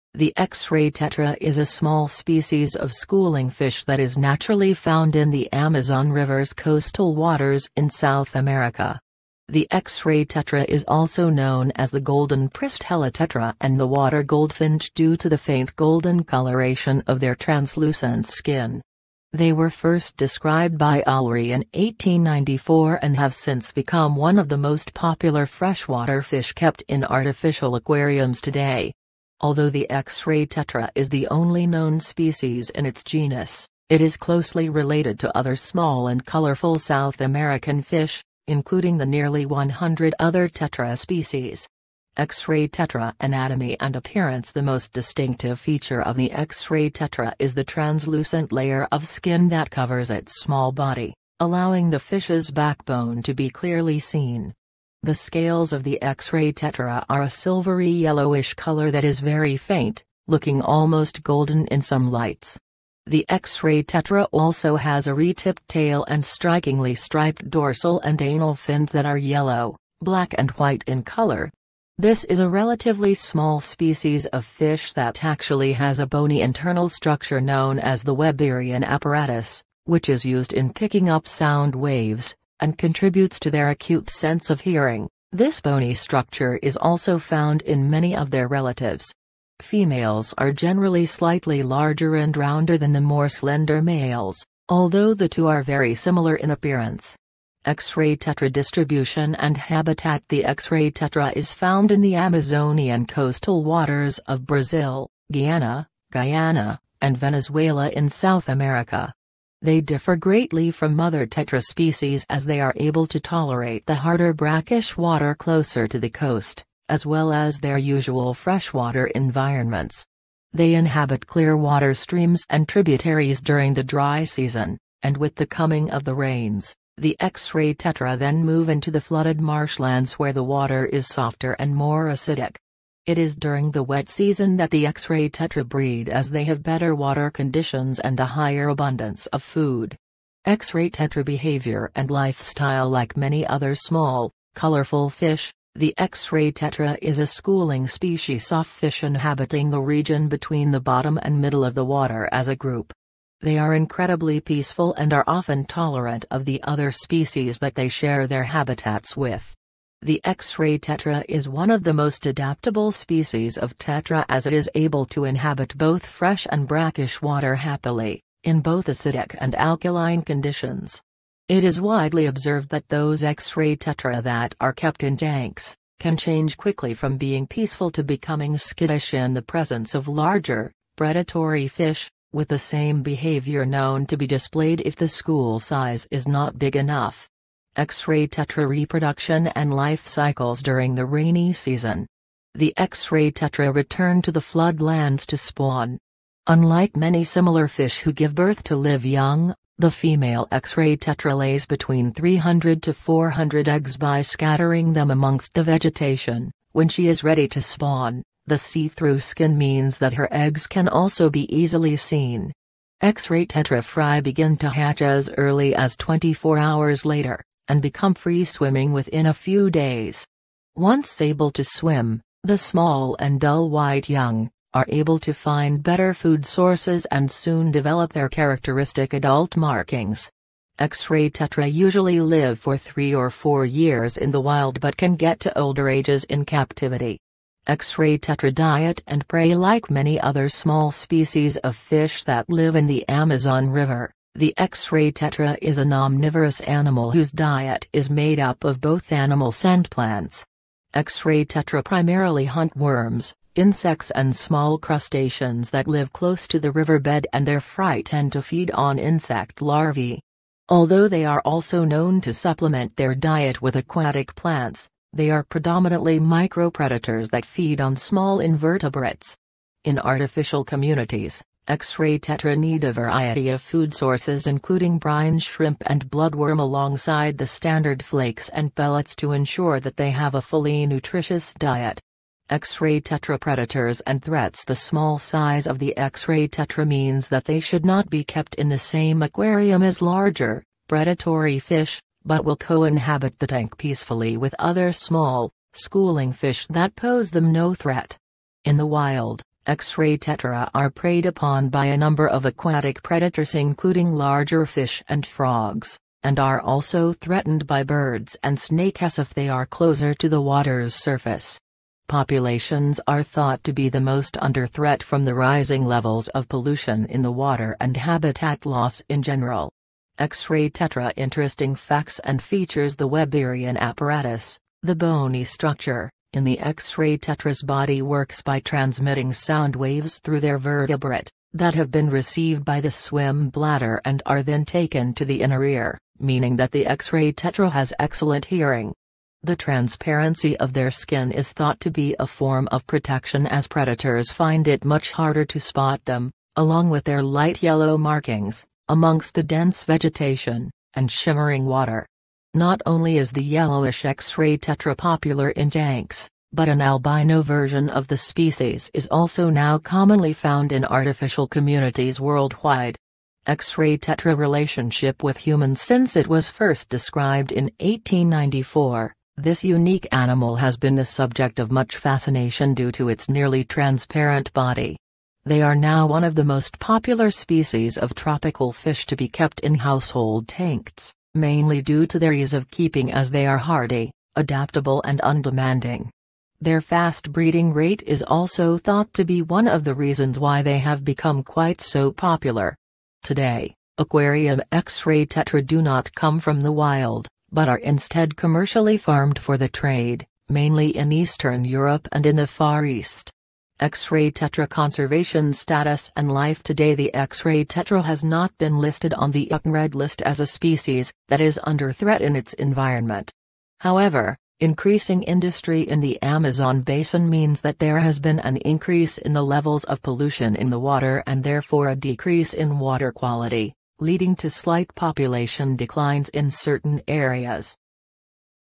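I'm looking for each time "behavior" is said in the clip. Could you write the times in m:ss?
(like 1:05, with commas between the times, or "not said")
2:21, 3:03.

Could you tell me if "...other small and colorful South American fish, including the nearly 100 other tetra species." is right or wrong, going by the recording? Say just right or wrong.
right.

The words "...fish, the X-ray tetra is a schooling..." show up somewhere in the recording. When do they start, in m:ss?
2:25.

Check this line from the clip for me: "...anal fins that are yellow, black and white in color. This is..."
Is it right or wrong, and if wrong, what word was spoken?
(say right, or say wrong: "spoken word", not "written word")
right.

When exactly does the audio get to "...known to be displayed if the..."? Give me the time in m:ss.
3:03.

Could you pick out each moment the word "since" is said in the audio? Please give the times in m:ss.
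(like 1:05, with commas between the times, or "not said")
0:23, 6:05.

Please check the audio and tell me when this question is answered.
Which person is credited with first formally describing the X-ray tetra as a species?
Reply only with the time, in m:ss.
0:21.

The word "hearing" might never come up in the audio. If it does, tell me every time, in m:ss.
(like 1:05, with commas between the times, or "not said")
1:24, 5:38.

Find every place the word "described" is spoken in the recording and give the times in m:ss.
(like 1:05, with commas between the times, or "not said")
0:20, 6:06.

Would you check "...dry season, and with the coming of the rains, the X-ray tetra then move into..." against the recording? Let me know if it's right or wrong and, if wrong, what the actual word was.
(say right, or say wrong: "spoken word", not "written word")
right.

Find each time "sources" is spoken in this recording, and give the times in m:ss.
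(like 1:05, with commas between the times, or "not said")
3:46, 4:33.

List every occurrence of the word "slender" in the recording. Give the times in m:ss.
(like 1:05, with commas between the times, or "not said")
1:33.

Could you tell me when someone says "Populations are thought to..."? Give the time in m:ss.
5:12.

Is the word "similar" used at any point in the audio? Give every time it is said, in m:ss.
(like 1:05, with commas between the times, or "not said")
1:35, 3:17.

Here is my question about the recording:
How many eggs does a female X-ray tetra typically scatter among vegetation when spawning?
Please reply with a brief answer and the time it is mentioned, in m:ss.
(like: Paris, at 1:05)
300 to 400, at 3:22.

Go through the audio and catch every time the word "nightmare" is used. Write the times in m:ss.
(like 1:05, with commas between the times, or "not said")
not said.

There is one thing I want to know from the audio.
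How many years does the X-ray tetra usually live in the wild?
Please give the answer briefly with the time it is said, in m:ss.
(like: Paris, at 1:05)
3 or 4, at 3:52.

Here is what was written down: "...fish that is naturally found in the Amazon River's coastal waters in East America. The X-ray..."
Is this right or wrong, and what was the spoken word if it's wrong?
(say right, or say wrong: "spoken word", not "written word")
wrong: "South", not "East".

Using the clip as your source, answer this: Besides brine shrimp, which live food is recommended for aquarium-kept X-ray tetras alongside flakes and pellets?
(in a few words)
bloodworm.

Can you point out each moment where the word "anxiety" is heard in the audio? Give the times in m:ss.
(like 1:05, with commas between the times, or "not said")
not said.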